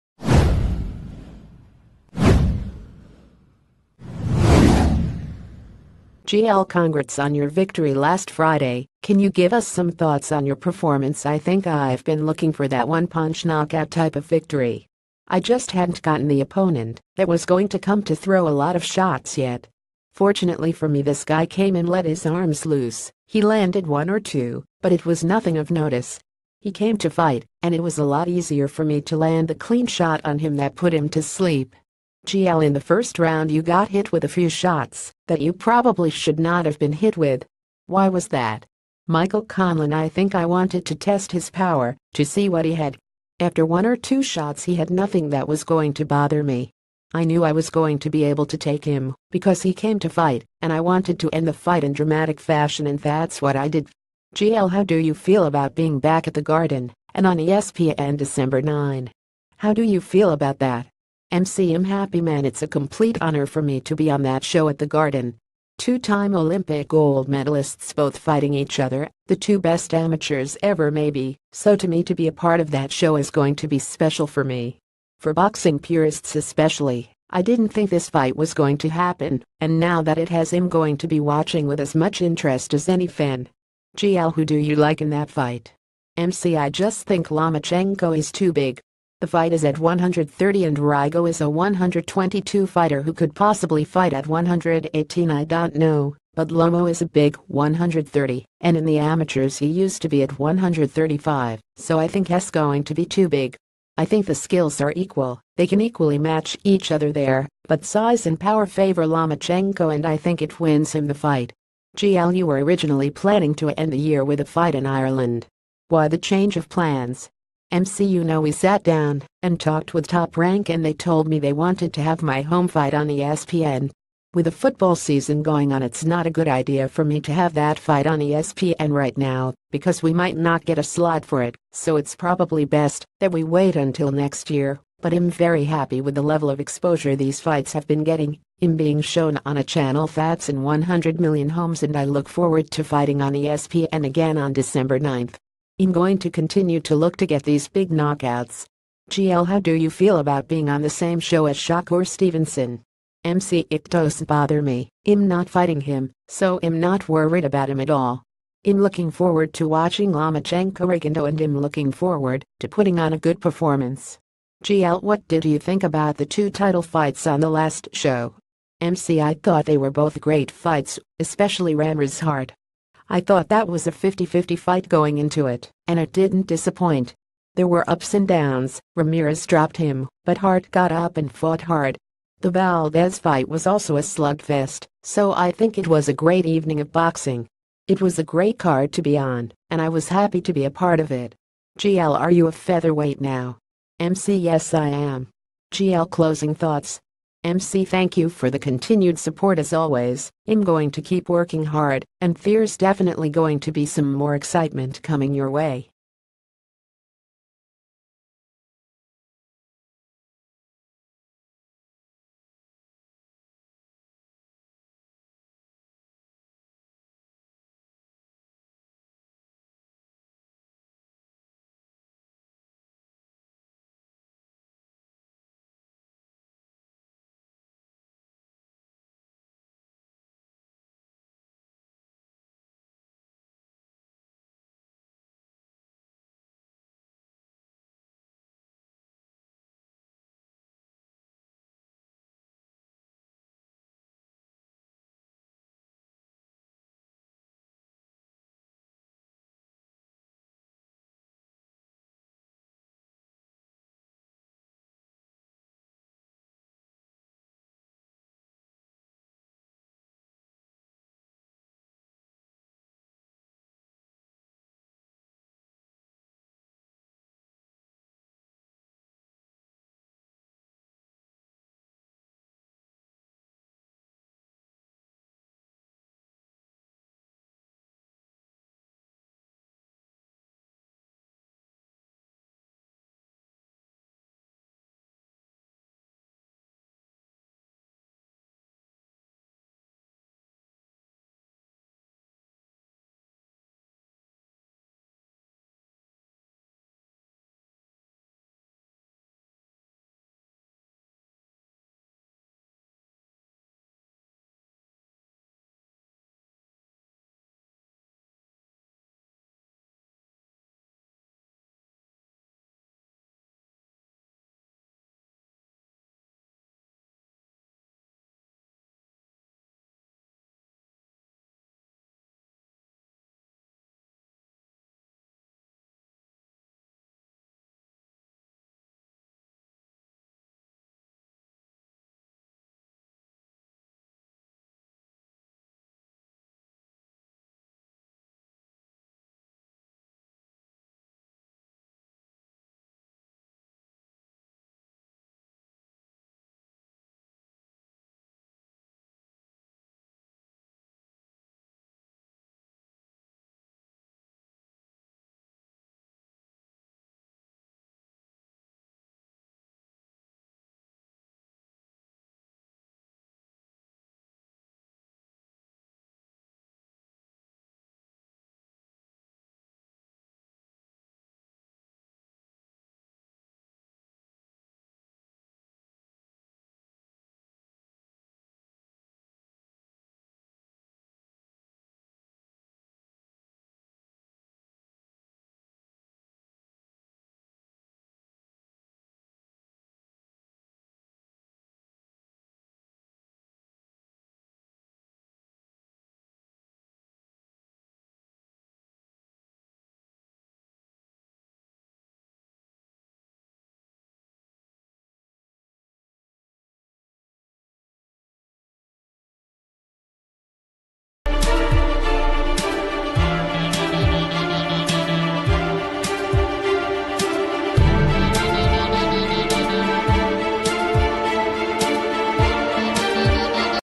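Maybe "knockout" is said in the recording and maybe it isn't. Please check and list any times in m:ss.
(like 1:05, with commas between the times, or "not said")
0:13, 2:27.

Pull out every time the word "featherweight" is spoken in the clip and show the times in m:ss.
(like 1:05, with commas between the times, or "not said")
3:12.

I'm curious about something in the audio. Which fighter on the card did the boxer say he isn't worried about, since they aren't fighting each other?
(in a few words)
Shakur Stevenson.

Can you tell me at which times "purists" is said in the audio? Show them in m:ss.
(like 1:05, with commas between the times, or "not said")
1:15.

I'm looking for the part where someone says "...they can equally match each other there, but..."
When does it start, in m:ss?
1:45.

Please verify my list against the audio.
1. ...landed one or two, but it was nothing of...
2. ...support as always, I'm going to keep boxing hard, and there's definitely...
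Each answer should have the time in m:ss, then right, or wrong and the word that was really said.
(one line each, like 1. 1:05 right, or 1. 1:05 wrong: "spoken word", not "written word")
1. 0:23 right
2. 3:19 wrong: "working", not "boxing".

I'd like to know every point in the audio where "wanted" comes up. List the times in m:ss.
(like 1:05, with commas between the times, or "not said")
0:40, 0:50, 2:01.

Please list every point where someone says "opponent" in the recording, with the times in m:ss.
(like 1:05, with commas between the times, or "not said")
0:16.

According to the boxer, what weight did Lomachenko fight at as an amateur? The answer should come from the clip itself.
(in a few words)
135.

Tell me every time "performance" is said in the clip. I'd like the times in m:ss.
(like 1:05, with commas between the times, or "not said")
0:10, 2:43.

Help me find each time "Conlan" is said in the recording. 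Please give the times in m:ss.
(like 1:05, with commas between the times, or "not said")
0:39.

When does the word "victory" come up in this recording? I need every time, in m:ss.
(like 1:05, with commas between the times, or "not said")
0:07, 0:14.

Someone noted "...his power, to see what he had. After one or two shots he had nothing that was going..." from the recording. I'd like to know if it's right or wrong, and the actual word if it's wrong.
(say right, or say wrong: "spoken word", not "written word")
right.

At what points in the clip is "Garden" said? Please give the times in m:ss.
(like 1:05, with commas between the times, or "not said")
0:56, 1:04.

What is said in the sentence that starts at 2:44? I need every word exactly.
GL What did you think about the two title fights on the last show?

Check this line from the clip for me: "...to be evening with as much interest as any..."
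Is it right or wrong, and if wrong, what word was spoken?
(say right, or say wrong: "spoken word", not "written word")
wrong: "watching", not "evening".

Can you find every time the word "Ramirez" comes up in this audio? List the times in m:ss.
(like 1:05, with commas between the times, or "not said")
2:51, 2:58.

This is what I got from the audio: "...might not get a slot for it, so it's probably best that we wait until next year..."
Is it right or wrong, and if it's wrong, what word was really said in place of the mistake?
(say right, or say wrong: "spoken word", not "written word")
right.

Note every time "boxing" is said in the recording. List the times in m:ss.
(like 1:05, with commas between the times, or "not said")
1:15, 3:06.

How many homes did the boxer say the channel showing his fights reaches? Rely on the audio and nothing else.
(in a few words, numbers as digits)
100 million.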